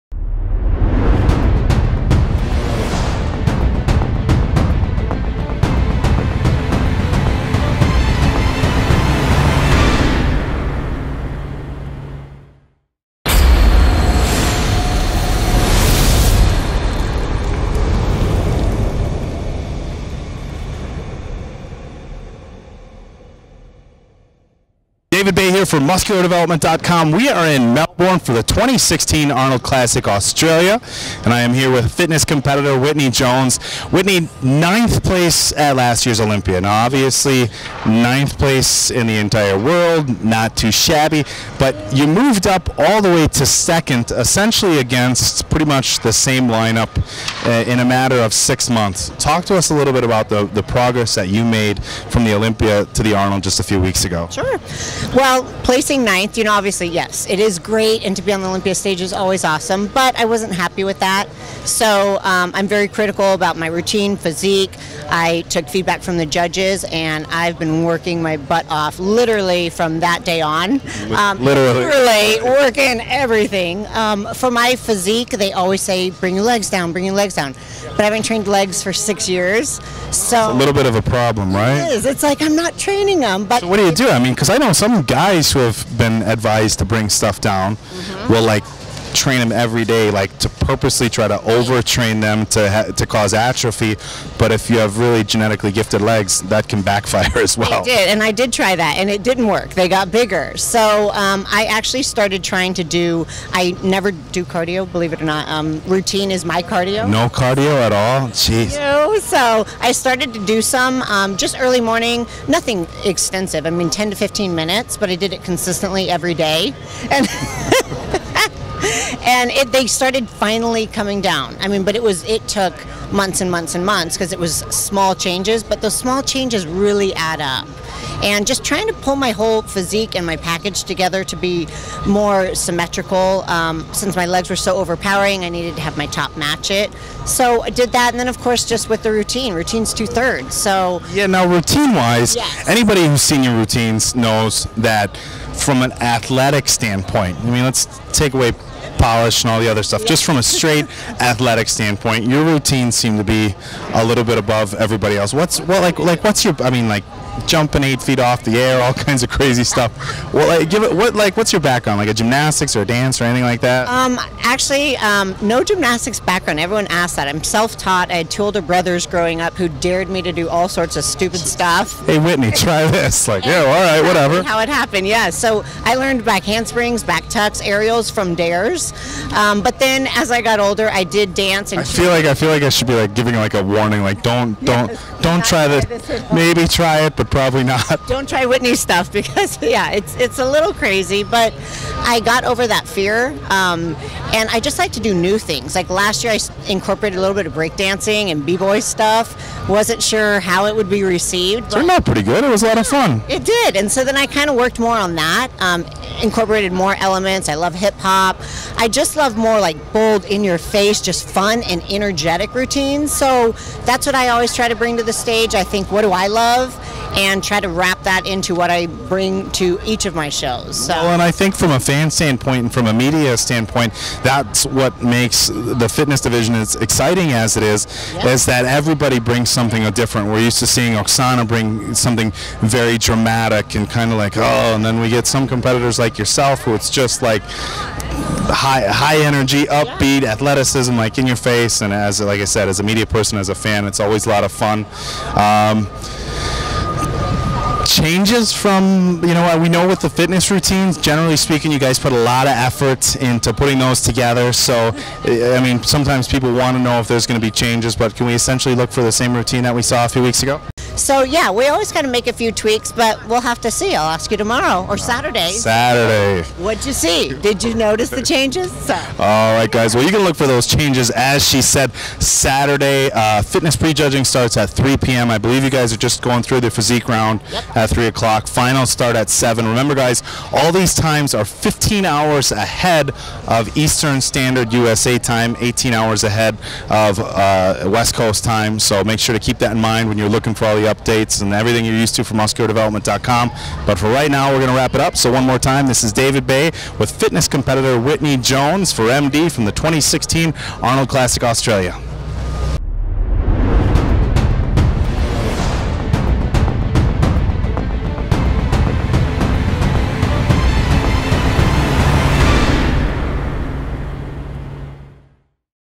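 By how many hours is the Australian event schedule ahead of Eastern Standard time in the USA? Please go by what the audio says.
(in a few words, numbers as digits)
15.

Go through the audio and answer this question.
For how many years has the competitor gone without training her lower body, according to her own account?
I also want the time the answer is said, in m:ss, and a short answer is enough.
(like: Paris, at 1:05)
6, at 1:18.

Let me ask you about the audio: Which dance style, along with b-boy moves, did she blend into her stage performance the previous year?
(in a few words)
Breakdancing.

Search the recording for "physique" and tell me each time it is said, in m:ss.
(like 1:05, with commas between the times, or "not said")
1:04, 1:14, 2:09, 4:36.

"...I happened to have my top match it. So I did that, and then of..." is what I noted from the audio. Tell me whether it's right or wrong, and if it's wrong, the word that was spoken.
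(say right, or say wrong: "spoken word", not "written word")
wrong: "needed", not "happened".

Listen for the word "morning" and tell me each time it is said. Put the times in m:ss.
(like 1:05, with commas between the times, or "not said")
1:51.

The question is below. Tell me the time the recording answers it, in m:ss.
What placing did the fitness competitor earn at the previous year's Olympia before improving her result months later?
0:34.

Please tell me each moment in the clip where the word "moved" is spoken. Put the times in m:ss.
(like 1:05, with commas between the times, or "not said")
0:42.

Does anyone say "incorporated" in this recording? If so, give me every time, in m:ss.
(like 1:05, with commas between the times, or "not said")
3:16, 3:26.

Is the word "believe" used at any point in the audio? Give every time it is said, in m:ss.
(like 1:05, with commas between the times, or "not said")
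1:44, 4:35.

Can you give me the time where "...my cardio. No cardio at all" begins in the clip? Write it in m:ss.
1:46.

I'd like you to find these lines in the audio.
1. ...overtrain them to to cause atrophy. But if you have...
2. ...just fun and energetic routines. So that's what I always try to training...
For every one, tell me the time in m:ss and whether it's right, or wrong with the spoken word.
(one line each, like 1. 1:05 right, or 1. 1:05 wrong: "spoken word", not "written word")
1. 1:31 right
2. 3:31 wrong: "bring", not "training".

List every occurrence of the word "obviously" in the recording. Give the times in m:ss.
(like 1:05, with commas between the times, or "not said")
0:36, 0:56.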